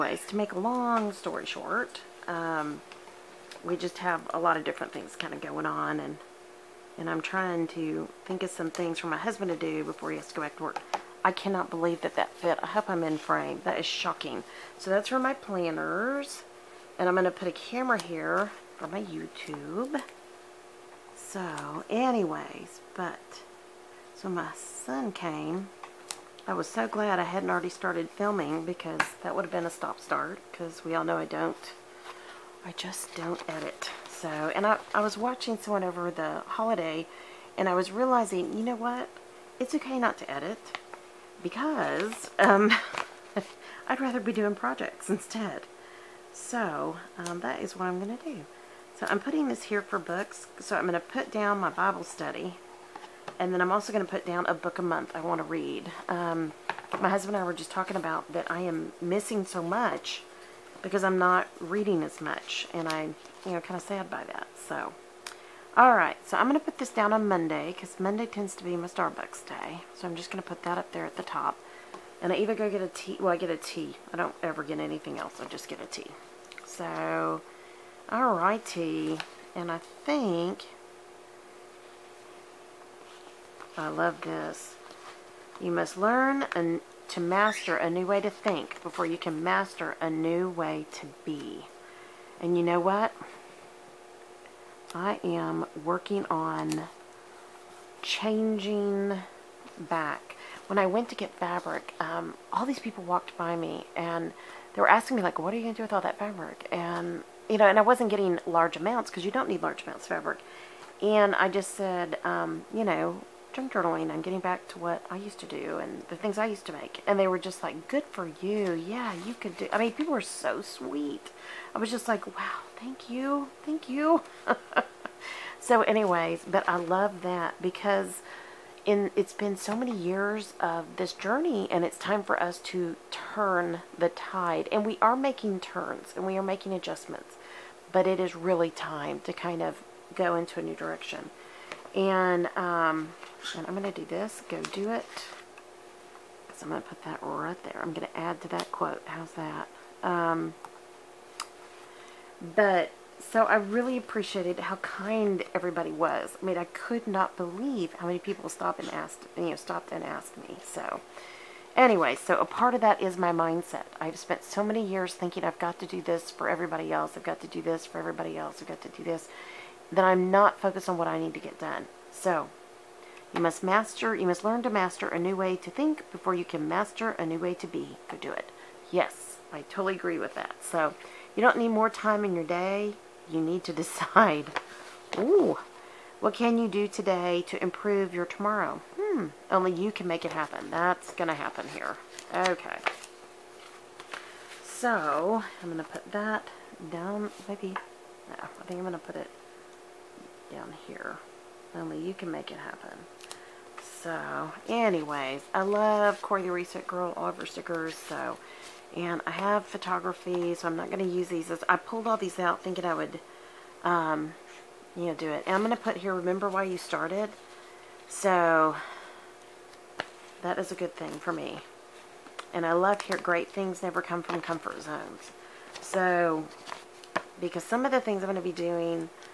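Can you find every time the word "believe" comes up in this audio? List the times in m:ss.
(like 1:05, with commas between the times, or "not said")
0:11, 2:37.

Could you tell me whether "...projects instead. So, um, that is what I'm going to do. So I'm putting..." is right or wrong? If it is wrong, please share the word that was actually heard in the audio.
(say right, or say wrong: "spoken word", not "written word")
right.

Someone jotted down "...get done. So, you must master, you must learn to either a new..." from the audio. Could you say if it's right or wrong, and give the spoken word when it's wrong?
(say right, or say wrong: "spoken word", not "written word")
wrong: "master", not "either".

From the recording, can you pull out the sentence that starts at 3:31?
I pulled all these out thinking I would, um, you know, do it.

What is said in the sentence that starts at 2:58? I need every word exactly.
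Yes, I totally agree with that.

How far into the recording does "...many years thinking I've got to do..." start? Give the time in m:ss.
2:44.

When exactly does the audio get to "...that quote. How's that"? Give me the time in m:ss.
2:28.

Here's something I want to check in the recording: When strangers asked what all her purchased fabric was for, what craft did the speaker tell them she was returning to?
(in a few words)
Junk journaling.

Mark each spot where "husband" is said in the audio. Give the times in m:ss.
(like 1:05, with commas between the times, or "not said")
0:09, 0:57.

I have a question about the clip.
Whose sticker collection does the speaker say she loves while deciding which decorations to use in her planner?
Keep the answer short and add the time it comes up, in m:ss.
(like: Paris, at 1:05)
Corie the Reset Girl, at 3:26.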